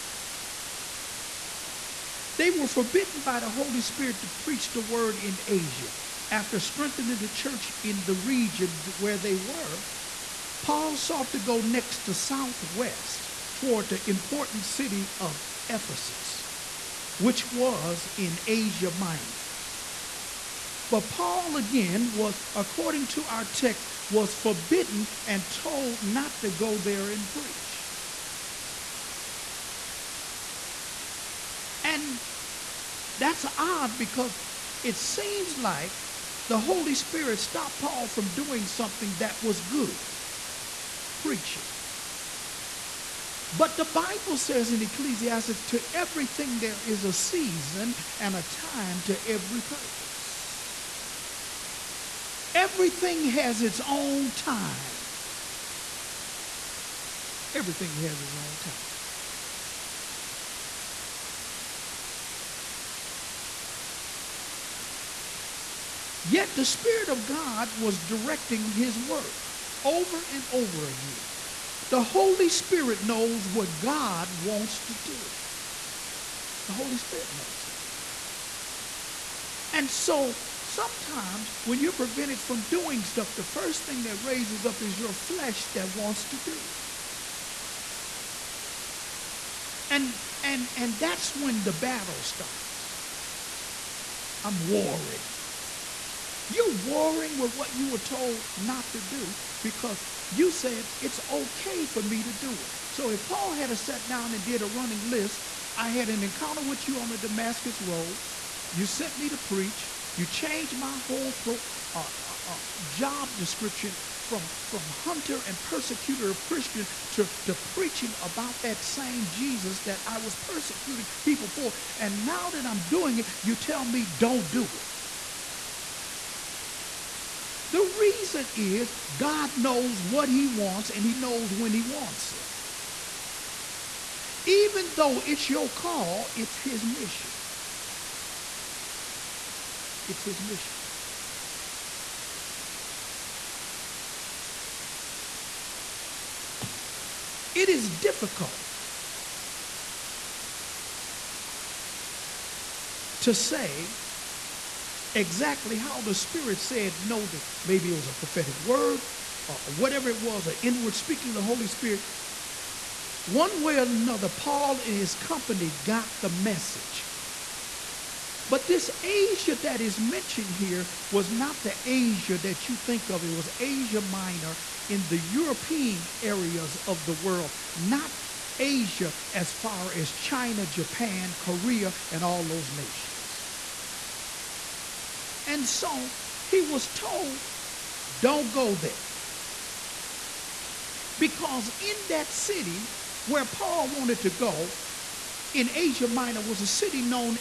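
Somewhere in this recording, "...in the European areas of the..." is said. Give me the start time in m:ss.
2:54.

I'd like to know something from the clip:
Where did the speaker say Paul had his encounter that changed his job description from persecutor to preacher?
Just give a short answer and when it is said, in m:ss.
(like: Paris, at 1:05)
Damascus Road, at 1:47.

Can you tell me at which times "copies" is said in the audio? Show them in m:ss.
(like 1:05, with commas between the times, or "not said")
not said.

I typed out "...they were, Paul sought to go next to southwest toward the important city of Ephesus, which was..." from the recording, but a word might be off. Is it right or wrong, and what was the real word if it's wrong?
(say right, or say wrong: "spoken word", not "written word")
right.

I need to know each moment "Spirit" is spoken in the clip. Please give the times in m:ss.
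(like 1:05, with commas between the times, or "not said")
0:03, 0:36, 1:06, 1:12, 1:16, 2:36, 2:41.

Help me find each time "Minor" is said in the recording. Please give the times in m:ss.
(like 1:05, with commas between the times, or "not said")
0:18, 2:53, 3:16.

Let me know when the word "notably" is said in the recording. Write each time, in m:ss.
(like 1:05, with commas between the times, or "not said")
not said.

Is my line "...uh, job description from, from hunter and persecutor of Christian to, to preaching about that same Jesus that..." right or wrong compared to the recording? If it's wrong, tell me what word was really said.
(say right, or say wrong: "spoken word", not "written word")
right.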